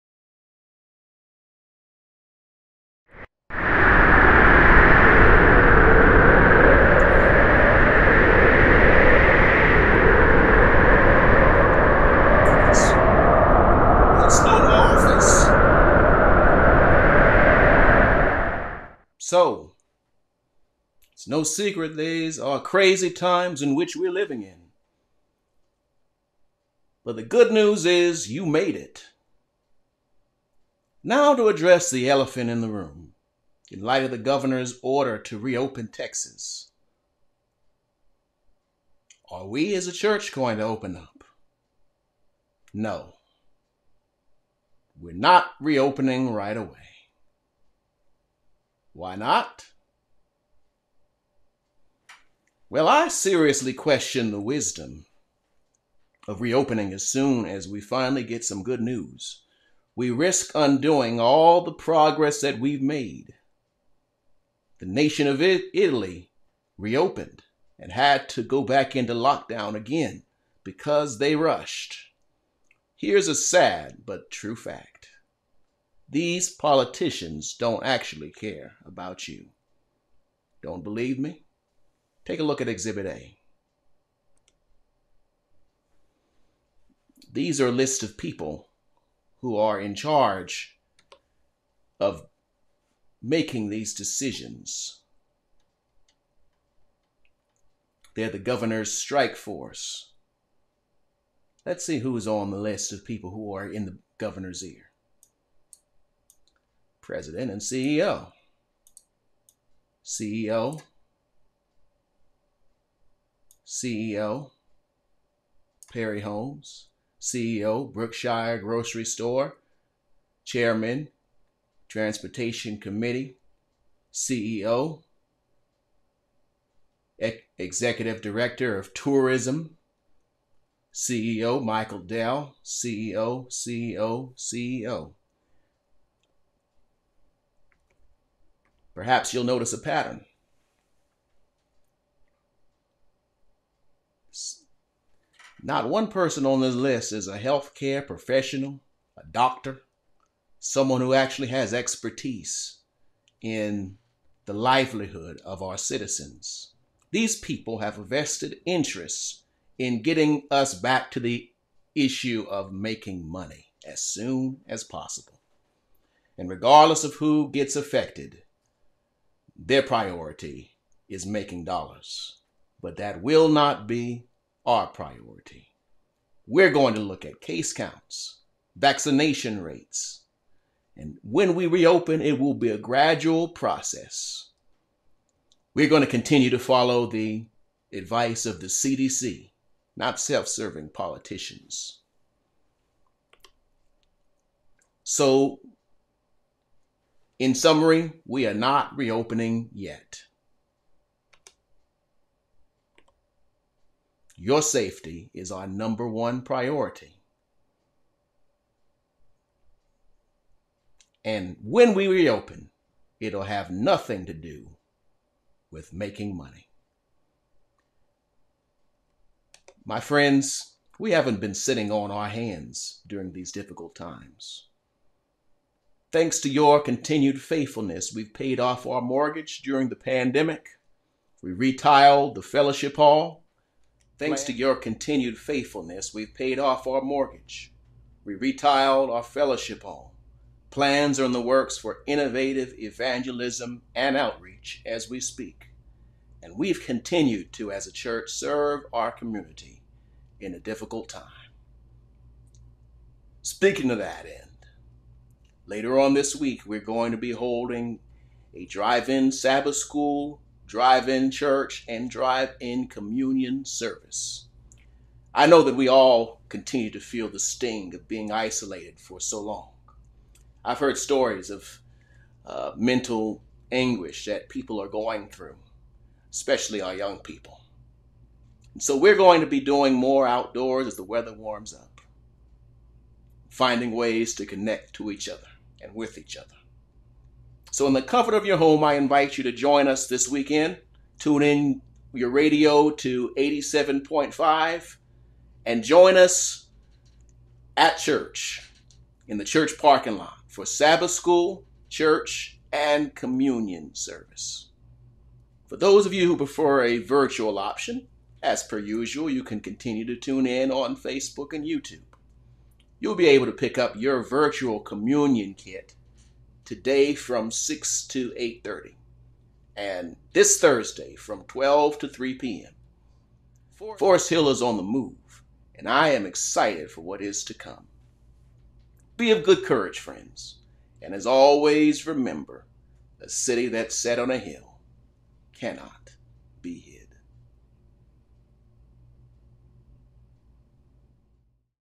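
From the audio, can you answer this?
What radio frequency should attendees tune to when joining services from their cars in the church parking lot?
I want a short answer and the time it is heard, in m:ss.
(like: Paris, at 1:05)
87.5, at 4:53.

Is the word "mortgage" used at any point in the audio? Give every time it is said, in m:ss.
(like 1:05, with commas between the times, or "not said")
3:49, 3:57.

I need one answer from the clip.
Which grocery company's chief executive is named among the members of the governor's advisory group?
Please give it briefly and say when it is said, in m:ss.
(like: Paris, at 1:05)
Brookshire Grocery, at 1:57.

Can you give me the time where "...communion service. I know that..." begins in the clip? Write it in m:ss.
4:22.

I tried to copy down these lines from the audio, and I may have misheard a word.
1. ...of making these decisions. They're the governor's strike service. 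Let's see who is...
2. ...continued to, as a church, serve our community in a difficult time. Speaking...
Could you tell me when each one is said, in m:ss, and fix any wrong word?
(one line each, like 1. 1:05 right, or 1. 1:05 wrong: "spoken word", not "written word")
1. 1:31 wrong: "force", not "service"
2. 4:06 right.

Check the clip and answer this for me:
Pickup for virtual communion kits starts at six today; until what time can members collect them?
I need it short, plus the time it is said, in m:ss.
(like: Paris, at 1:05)
8:30, at 5:18.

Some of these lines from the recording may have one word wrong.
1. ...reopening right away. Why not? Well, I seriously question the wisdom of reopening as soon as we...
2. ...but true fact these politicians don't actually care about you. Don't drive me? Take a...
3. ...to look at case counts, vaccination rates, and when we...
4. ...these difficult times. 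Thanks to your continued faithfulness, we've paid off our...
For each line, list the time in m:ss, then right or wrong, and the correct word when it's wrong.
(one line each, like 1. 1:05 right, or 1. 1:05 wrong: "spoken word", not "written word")
1. 0:45 right
2. 1:14 wrong: "believe", not "drive"
3. 2:56 right
4. 3:43 right.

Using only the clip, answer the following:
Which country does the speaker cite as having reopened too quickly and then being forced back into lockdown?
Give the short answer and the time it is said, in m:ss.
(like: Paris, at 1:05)
Italy, at 1:05.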